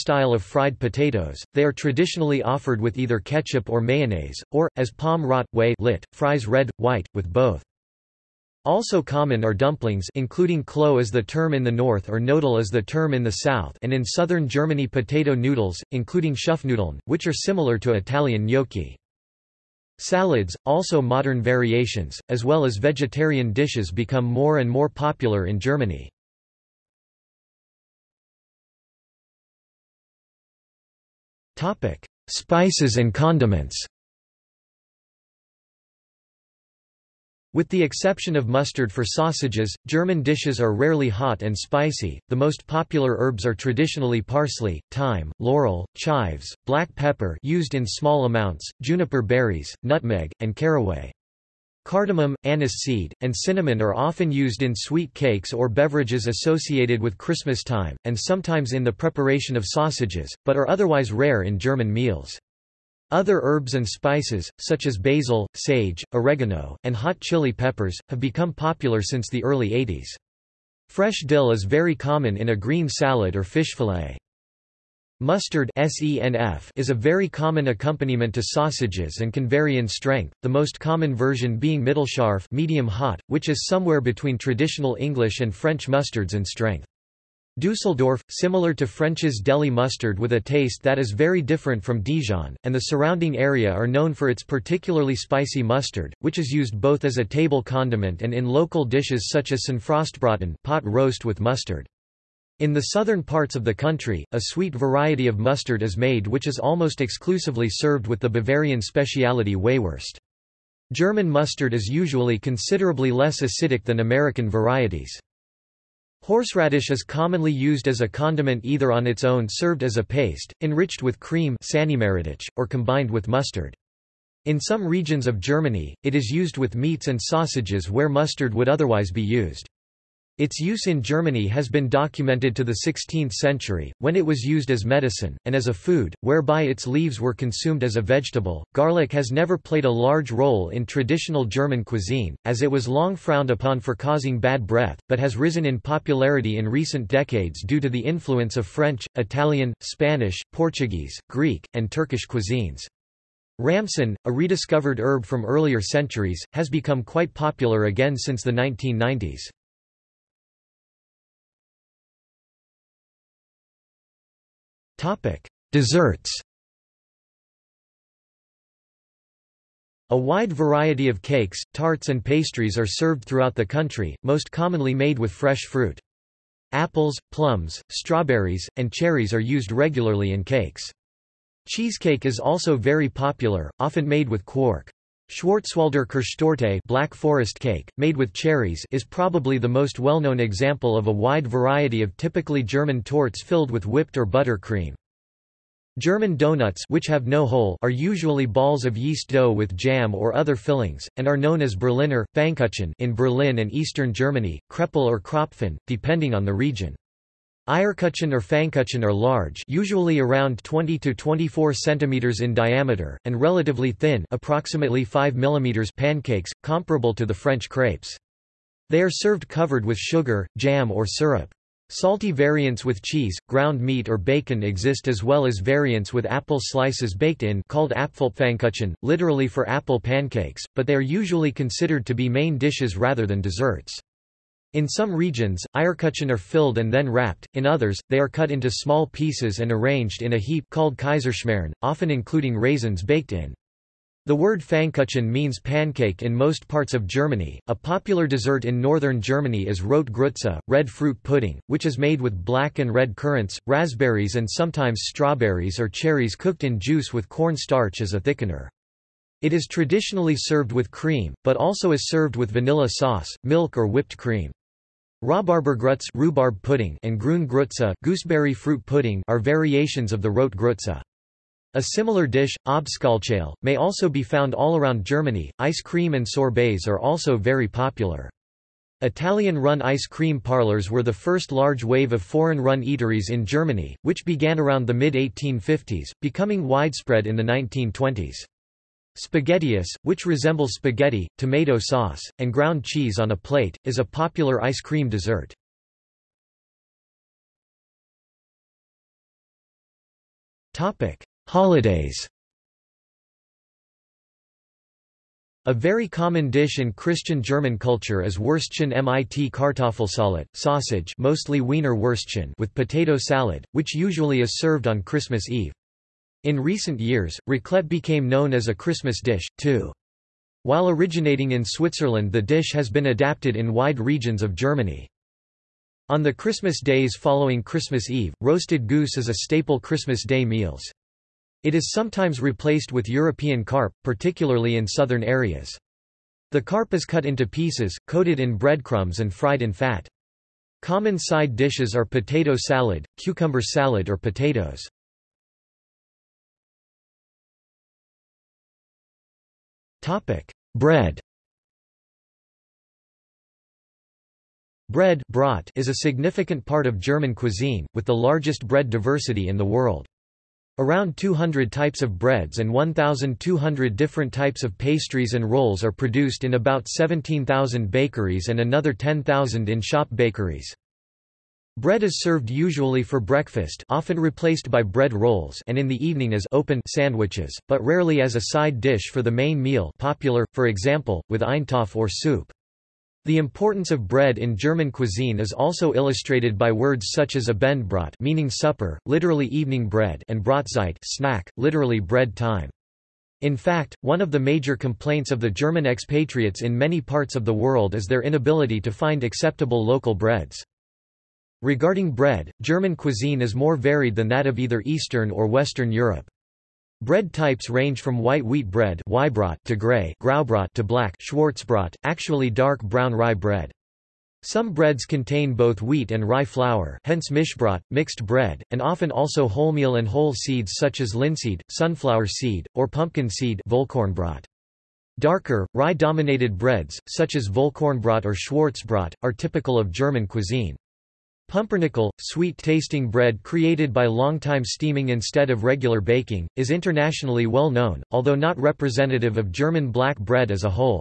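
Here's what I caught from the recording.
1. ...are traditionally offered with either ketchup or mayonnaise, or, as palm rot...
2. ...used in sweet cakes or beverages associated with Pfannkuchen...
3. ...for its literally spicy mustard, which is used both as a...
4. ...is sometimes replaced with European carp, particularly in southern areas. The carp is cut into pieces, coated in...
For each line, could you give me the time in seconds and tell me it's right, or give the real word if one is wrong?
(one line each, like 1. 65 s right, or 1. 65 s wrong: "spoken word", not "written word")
1. 1 s right
2. 54 s wrong: "Christmas", not "Pfannkuchen"
3. 94 s wrong: "particularly", not "literally"
4. 331 s right.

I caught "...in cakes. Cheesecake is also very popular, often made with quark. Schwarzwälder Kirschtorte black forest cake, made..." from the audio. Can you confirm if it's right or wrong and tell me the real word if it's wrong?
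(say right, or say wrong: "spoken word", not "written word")
right.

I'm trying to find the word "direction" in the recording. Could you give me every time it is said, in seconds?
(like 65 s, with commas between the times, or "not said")
not said.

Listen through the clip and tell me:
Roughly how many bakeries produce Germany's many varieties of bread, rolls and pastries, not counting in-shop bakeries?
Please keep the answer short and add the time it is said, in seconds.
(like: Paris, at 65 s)
17,000, at 366 s.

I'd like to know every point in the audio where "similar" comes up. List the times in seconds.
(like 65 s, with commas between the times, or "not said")
17 s, 88 s, 271 s.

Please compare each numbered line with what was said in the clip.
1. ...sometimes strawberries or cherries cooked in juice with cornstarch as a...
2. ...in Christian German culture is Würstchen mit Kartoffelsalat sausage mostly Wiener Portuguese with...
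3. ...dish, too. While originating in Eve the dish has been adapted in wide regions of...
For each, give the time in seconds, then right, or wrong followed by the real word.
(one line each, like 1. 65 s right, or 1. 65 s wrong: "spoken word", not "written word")
1. 254 s right
2. 306 s wrong: "Würstchen", not "Portuguese"
3. 319 s wrong: "Switzerland", not "Eve".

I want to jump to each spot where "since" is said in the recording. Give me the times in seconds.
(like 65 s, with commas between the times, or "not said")
69 s, 158 s.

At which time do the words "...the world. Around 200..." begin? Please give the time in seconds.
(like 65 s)
359 s.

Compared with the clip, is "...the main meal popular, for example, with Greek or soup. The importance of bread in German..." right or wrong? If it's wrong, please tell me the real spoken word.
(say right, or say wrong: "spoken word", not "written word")
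wrong: "Eintopf", not "Greek".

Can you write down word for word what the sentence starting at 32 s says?
Spices and condiments With the exception of mustard for sausages, German dishes are rarely hot and spicy.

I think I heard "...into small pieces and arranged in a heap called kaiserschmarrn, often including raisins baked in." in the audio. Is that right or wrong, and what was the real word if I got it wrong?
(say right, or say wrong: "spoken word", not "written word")
right.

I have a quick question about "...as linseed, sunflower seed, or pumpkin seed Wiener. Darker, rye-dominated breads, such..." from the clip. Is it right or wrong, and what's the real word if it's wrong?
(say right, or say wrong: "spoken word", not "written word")
wrong: "Vollkornbrot", not "Wiener".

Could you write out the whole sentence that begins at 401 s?
Regarding bread, German cuisine is more varied than that of either Eastern or Western Europe.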